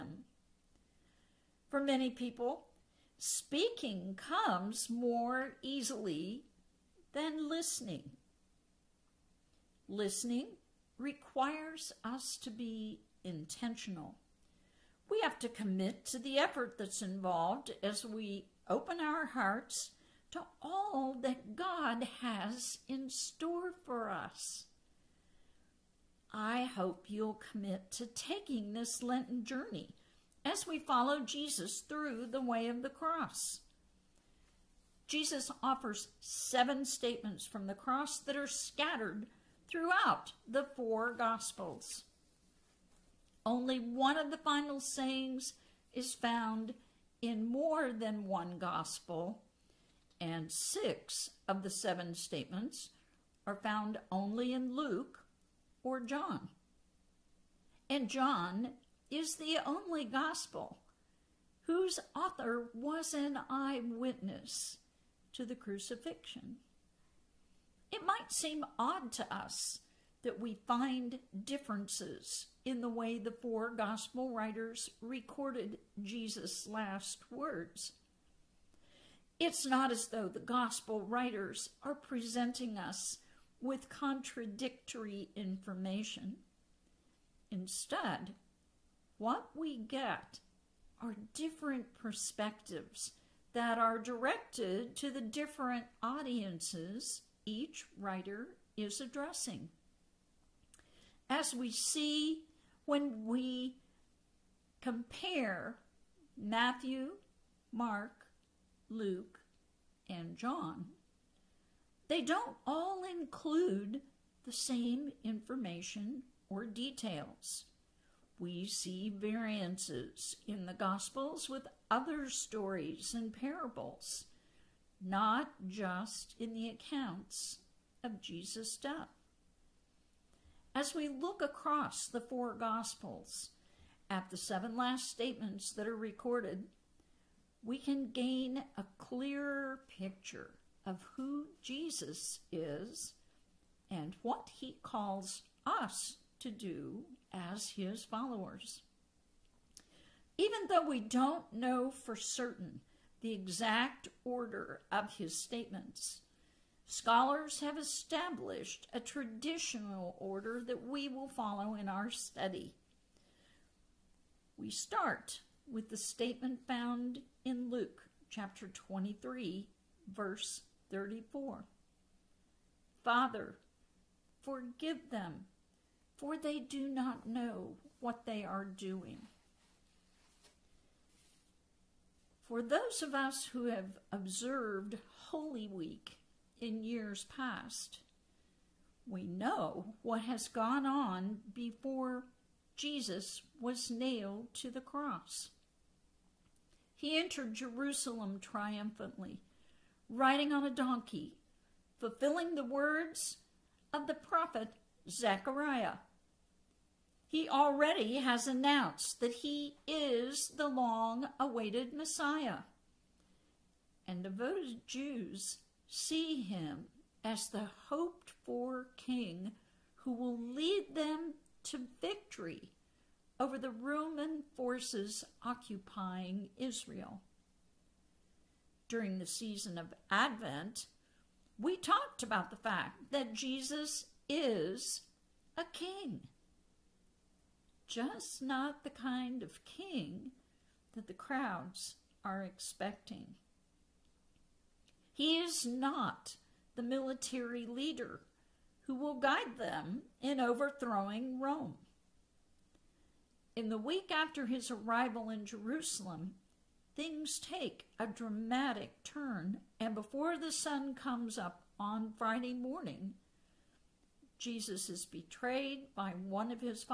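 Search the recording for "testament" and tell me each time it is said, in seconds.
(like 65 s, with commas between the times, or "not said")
not said.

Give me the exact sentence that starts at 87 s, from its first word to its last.
Instead, what we get are different perspectives that are directed to the different audiences each writer is addressing.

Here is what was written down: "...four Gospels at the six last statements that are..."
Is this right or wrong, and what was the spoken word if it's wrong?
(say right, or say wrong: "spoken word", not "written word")
wrong: "seven", not "six".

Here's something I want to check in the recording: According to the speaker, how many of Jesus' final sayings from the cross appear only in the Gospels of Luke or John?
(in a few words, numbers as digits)
6.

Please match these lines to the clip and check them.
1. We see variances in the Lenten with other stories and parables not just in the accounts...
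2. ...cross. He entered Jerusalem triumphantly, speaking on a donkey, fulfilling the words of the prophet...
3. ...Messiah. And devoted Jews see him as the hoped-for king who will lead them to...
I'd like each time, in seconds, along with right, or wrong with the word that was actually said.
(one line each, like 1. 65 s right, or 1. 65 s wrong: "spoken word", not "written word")
1. 118 s wrong: "Gospels", not "Lenten"
2. 194 s wrong: "riding", not "speaking"
3. 211 s right.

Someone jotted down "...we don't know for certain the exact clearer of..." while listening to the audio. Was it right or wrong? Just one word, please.
wrong.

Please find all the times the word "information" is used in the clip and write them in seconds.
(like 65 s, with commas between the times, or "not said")
85 s, 115 s.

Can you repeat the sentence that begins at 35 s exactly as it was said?
Jesus offers seven statements from the cross that are scattered throughout the four Gospels.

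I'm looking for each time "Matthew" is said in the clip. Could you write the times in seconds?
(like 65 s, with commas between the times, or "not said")
106 s.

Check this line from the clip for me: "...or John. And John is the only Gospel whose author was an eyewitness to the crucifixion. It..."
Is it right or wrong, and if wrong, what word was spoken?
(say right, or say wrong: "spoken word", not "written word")
right.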